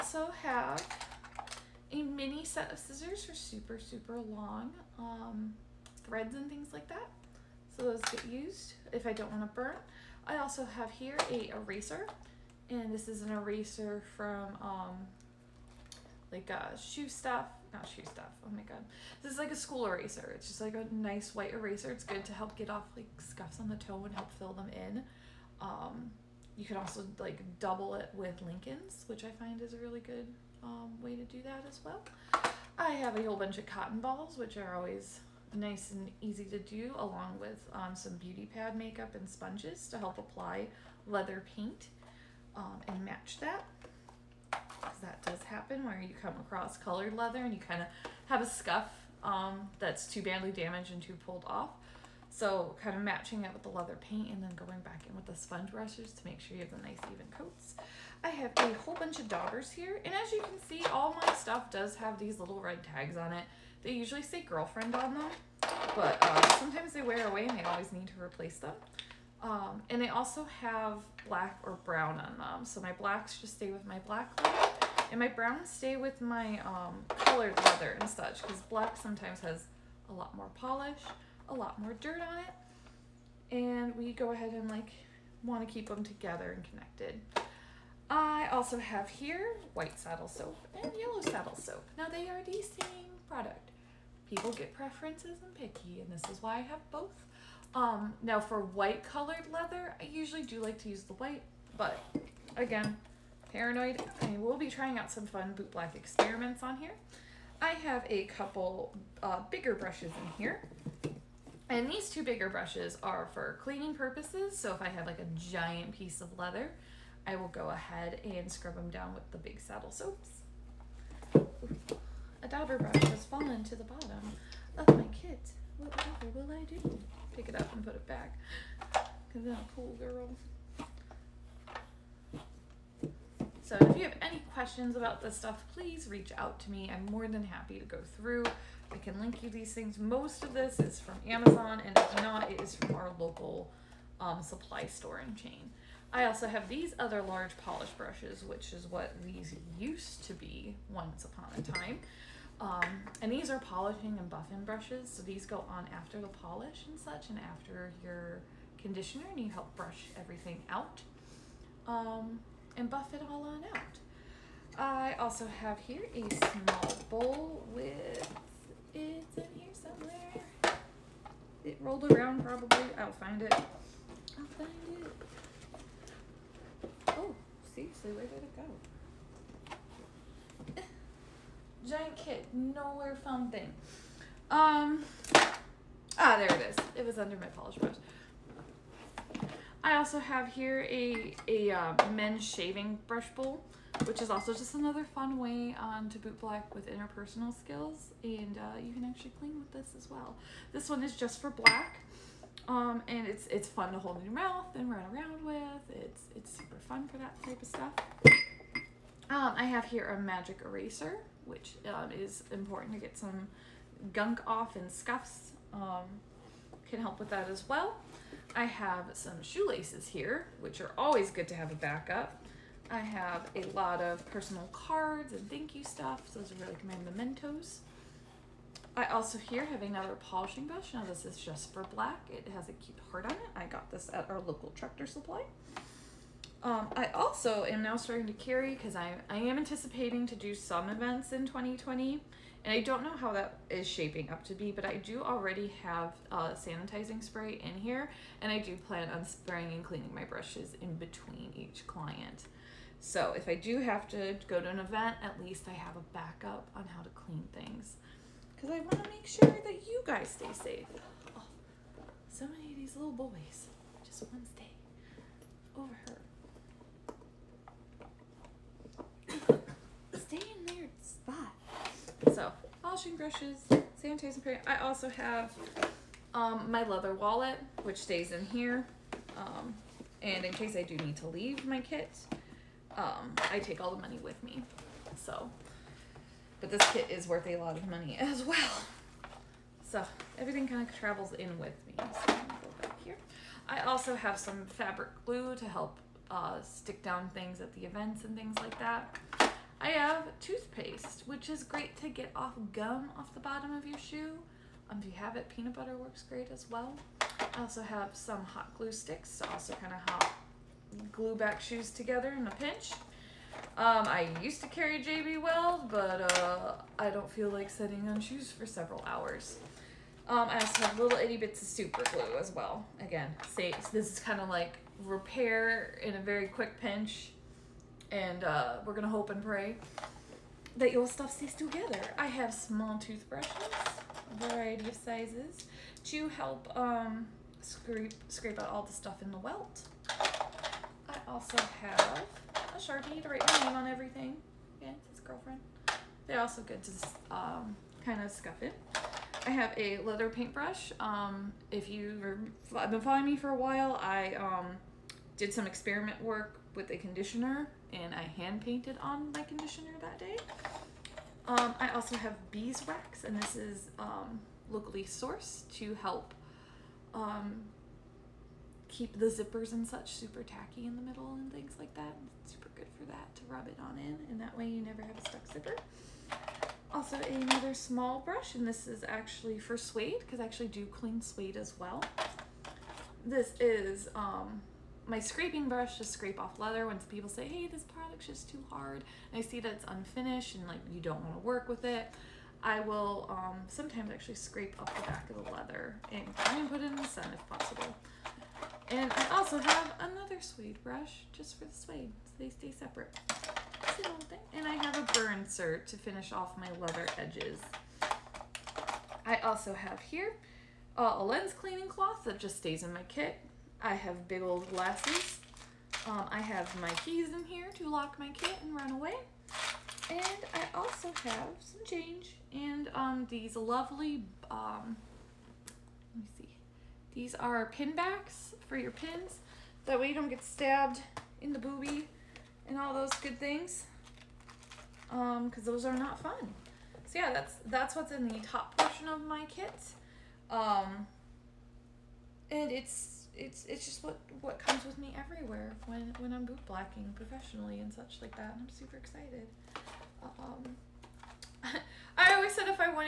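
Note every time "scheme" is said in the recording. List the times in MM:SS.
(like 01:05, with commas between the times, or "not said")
not said.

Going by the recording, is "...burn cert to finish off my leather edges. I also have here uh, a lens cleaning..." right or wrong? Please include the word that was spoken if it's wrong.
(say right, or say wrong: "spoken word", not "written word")
right.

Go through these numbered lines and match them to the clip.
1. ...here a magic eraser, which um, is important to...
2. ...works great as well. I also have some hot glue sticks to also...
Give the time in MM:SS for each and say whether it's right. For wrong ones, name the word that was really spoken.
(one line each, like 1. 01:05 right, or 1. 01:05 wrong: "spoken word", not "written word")
1. 03:29 right
2. 05:05 right.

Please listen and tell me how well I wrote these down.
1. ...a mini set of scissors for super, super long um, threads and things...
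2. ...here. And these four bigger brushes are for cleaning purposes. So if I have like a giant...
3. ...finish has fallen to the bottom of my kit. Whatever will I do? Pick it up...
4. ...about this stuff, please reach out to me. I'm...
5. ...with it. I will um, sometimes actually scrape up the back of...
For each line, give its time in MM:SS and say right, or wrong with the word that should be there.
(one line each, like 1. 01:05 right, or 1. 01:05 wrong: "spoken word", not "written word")
1. 00:01 right
2. 01:50 wrong: "two", not "four"
3. 02:02 wrong: "brush", not "finish"
4. 02:14 right
5. 06:31 right.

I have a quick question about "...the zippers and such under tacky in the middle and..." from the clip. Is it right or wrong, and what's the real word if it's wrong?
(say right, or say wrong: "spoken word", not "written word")
wrong: "super", not "under".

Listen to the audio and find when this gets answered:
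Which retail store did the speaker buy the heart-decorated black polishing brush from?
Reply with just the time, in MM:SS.
03:54.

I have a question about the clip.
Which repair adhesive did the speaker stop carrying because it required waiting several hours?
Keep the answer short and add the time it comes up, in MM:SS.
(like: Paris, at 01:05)
JB Weld, at 05:15.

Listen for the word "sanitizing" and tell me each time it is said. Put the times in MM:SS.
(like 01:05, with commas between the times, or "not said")
04:06, 04:34.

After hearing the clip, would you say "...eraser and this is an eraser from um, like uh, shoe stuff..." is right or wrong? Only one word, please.
right.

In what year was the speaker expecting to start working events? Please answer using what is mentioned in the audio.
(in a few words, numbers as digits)
2020.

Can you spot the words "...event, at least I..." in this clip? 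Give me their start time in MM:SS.
04:14.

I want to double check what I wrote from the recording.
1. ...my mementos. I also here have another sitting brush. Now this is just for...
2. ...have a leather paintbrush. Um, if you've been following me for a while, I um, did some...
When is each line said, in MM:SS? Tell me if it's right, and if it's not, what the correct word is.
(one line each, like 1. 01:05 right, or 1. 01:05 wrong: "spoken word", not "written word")
1. 03:46 wrong: "polishing", not "sitting"
2. 05:49 right.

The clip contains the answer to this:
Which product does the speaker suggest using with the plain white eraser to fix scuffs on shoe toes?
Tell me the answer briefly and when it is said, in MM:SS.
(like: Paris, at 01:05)
Lincolns, at 00:28.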